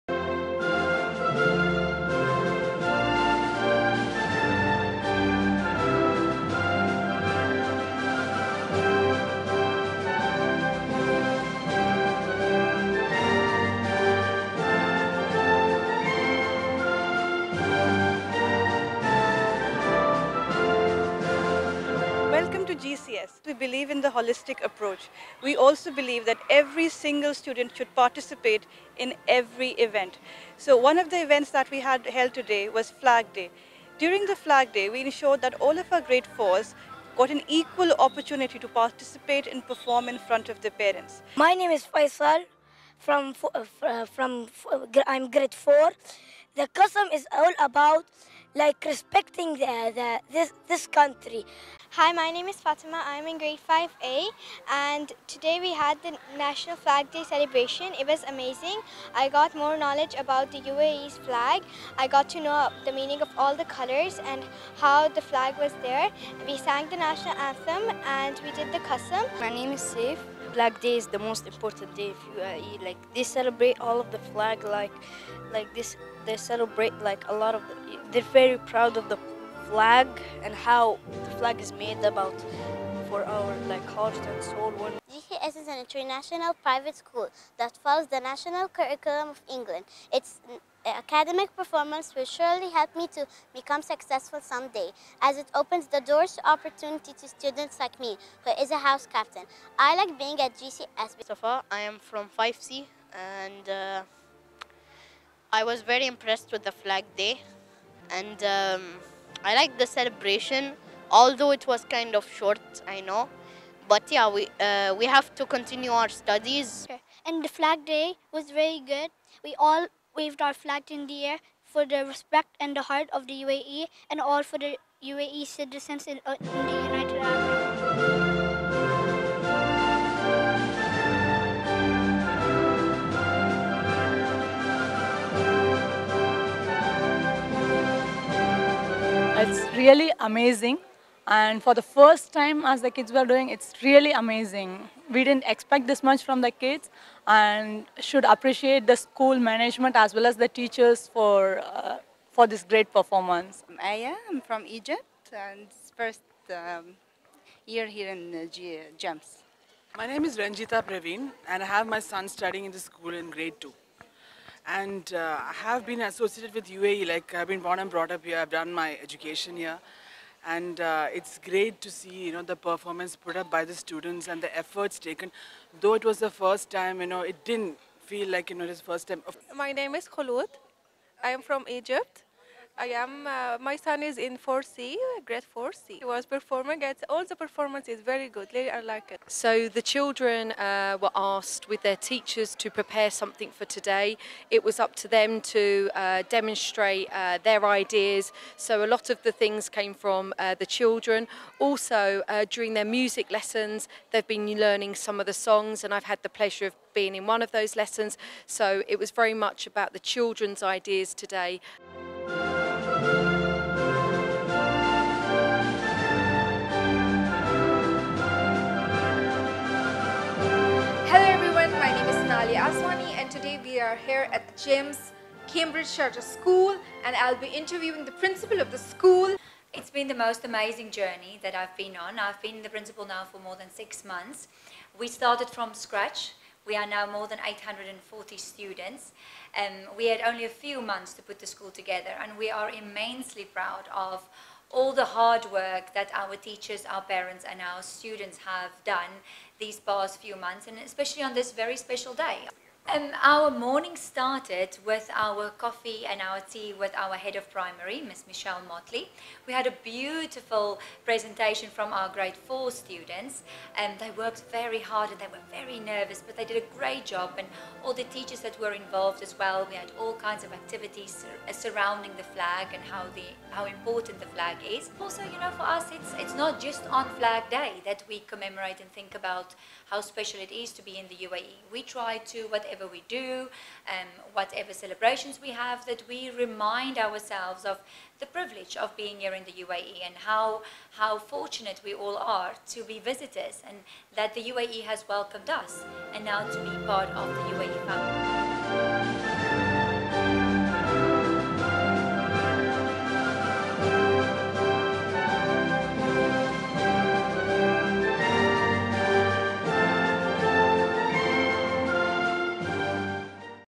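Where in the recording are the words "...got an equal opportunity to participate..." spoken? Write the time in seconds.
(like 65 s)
37 s.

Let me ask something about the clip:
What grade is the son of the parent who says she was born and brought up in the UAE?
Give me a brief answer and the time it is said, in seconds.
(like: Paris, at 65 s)
grade 2, at 163 s.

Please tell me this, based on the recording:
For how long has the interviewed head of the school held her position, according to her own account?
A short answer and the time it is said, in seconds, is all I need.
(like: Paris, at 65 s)
more than six months, at 233 s.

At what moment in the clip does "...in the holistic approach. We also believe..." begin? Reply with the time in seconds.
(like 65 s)
23 s.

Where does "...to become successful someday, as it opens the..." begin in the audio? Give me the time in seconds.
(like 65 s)
93 s.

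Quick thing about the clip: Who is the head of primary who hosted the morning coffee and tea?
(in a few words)
Michelle Motley.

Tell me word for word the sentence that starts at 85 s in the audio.
GCS is an international private school that follows the national curriculum of England.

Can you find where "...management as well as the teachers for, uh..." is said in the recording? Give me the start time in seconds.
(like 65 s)
149 s.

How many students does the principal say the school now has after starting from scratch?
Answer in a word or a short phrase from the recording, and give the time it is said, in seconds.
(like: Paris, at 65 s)
840, at 237 s.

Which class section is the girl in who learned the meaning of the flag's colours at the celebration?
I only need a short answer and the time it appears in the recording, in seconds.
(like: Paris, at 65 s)
5A, at 53 s.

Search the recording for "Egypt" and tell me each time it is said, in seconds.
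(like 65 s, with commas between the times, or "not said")
154 s, 181 s.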